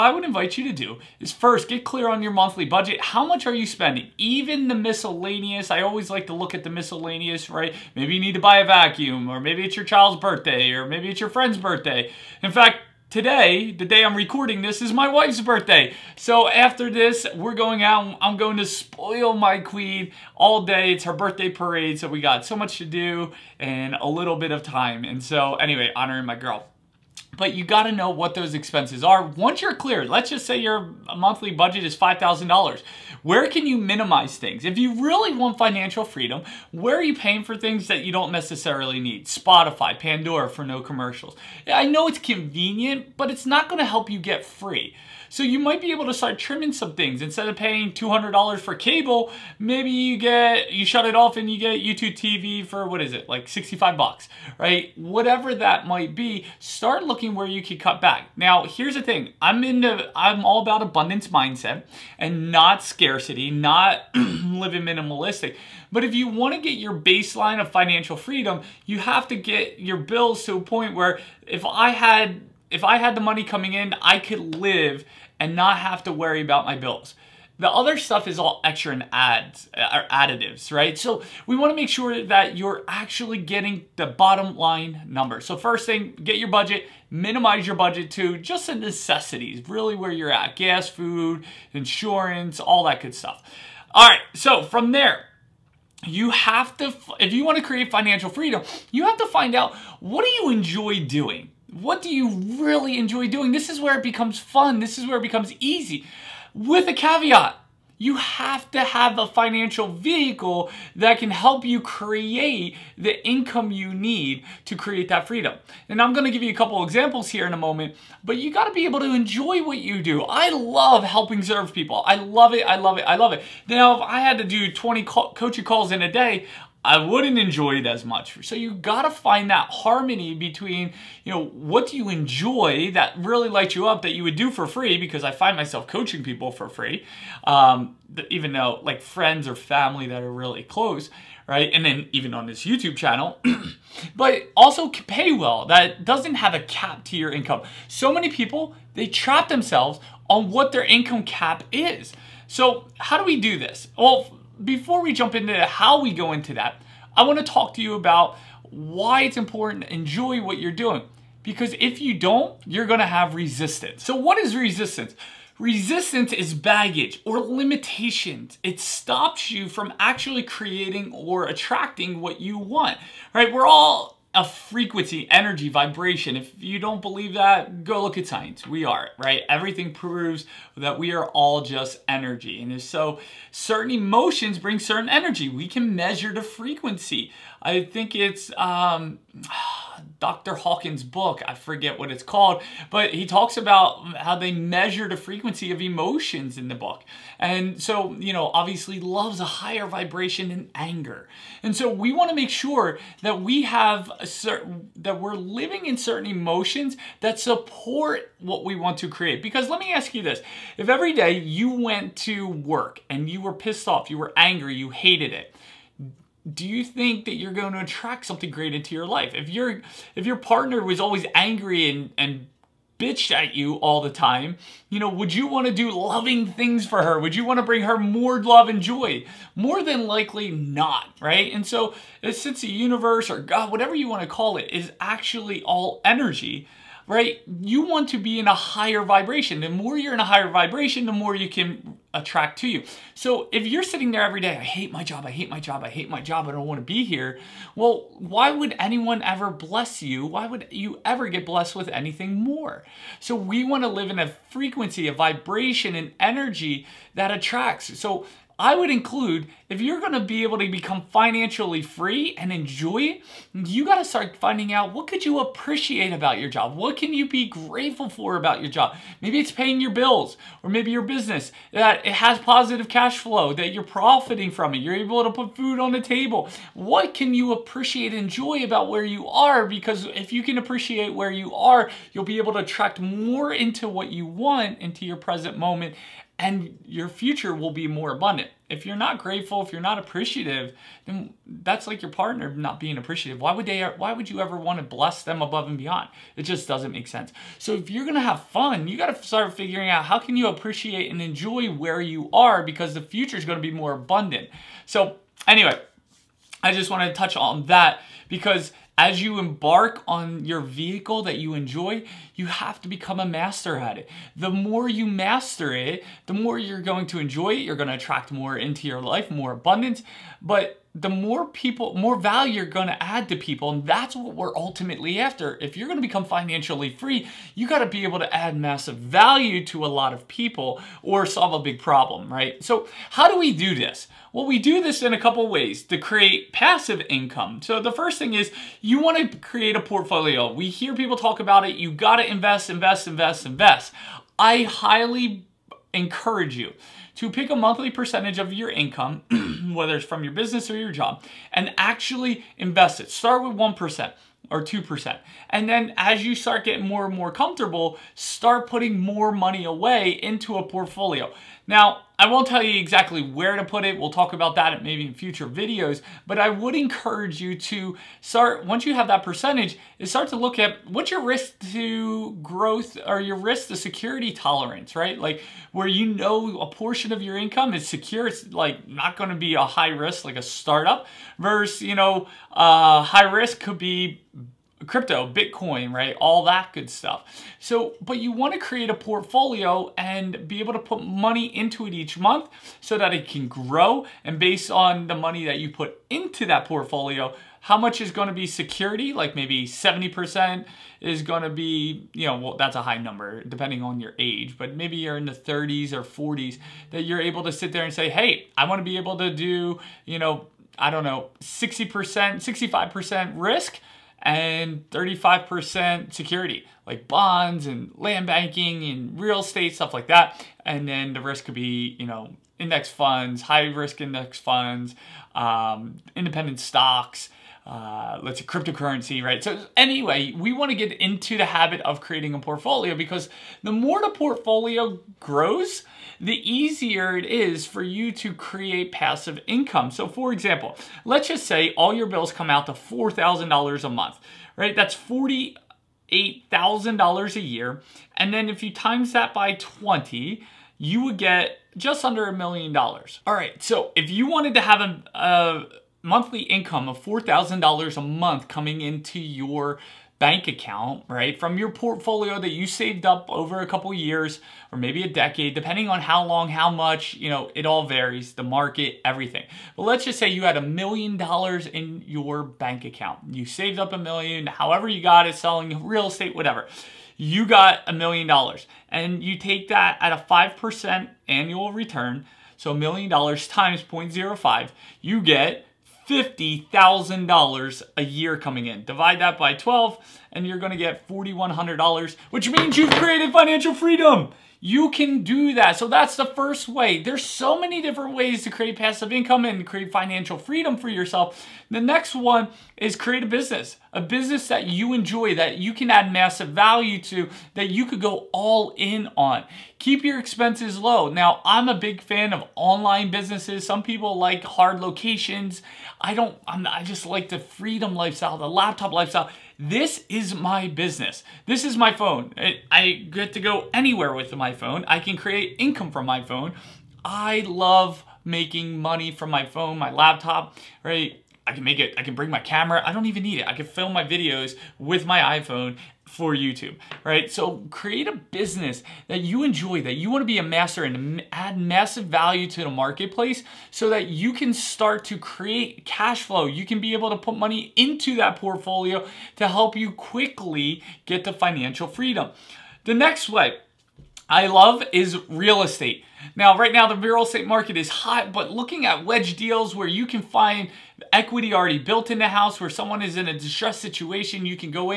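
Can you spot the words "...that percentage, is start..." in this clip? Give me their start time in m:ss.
6:09.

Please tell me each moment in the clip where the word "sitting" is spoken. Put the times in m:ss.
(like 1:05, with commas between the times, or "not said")
4:03.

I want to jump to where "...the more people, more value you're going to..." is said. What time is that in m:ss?
5:20.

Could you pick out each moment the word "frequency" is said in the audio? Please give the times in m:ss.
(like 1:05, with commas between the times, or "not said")
2:54, 3:06, 3:15, 4:14.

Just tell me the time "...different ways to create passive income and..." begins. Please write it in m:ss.
8:17.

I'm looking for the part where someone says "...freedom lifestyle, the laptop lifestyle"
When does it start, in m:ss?
8:37.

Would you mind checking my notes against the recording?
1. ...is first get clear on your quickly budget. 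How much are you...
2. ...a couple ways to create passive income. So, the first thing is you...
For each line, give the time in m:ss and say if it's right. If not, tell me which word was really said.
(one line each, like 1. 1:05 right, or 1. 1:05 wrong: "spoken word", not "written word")
1. 0:01 wrong: "monthly", not "quickly"
2. 5:35 right.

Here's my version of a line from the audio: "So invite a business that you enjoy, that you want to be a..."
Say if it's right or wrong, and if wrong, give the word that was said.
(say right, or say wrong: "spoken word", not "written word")
wrong: "create", not "invite".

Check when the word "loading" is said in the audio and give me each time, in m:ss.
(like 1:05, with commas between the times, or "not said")
not said.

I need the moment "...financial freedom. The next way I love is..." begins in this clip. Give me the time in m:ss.
9:11.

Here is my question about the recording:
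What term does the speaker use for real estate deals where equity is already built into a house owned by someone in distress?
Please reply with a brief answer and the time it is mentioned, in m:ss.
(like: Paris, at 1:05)
wedge deals, at 9:19.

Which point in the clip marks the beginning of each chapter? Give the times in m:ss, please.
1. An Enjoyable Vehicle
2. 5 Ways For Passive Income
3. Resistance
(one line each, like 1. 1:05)
1. 1:37
2. 5:37
3. 2:51.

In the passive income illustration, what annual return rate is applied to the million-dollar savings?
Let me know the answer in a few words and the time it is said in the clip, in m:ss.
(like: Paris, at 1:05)
5%, at 8:00.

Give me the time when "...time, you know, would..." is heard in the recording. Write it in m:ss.
3:44.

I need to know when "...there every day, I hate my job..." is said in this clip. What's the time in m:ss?
4:04.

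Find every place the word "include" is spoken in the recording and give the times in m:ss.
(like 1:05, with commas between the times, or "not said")
4:18.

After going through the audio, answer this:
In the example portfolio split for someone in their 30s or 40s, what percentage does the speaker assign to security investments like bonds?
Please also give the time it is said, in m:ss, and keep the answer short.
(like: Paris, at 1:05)
35%, at 6:54.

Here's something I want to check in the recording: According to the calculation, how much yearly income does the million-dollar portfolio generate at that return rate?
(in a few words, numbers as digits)
$50,000.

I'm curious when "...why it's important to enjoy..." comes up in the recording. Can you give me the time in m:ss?
2:38.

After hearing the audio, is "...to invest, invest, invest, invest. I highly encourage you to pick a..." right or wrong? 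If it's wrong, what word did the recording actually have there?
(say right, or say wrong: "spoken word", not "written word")
right.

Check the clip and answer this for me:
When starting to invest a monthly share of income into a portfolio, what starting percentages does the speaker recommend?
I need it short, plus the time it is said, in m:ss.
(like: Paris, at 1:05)
1% or 2%, at 5:53.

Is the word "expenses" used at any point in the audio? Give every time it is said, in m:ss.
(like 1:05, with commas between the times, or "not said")
0:28, 8:30.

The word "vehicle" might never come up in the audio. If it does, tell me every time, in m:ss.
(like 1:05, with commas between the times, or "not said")
1:49, 5:10.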